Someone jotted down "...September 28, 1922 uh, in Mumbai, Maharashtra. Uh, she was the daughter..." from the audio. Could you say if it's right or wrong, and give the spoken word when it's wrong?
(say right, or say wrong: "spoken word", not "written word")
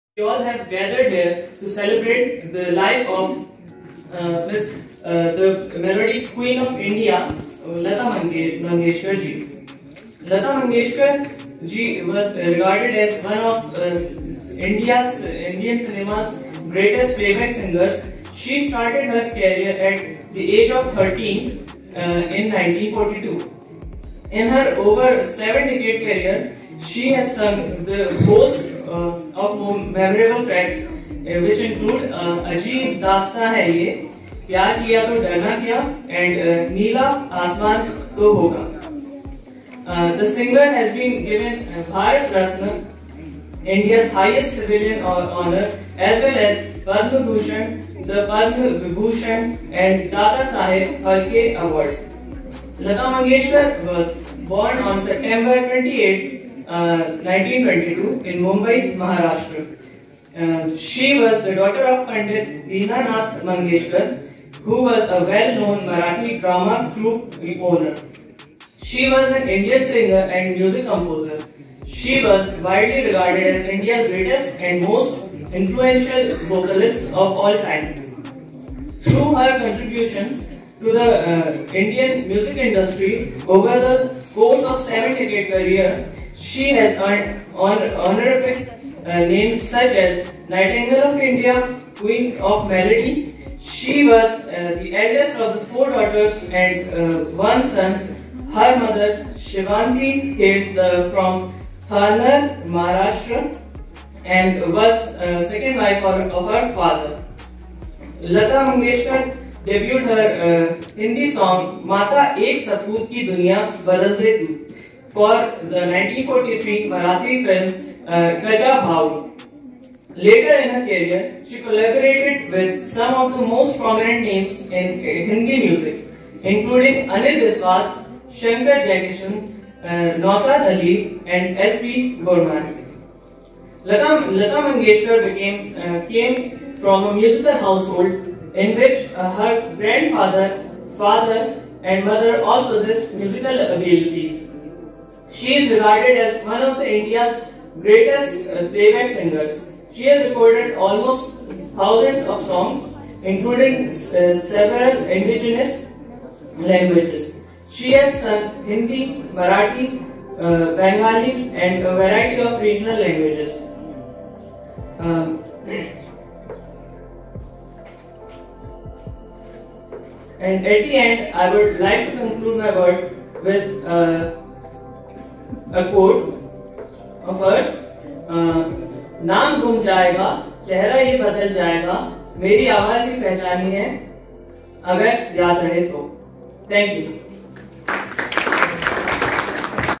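right.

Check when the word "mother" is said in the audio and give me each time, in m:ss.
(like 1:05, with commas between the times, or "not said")
1:38, 2:22.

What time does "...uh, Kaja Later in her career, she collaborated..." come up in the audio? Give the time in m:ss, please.
1:58.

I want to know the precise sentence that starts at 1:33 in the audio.
She was uh, the eldest of the four daughters and uh, one son.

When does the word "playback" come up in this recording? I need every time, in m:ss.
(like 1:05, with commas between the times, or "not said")
0:17, 2:28.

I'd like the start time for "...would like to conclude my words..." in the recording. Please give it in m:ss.
2:51.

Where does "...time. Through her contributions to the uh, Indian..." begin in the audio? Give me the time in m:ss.
1:17.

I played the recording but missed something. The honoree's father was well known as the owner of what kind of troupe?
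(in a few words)
Marathi drama troupe.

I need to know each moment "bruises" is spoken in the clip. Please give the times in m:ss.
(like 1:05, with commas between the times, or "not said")
not said.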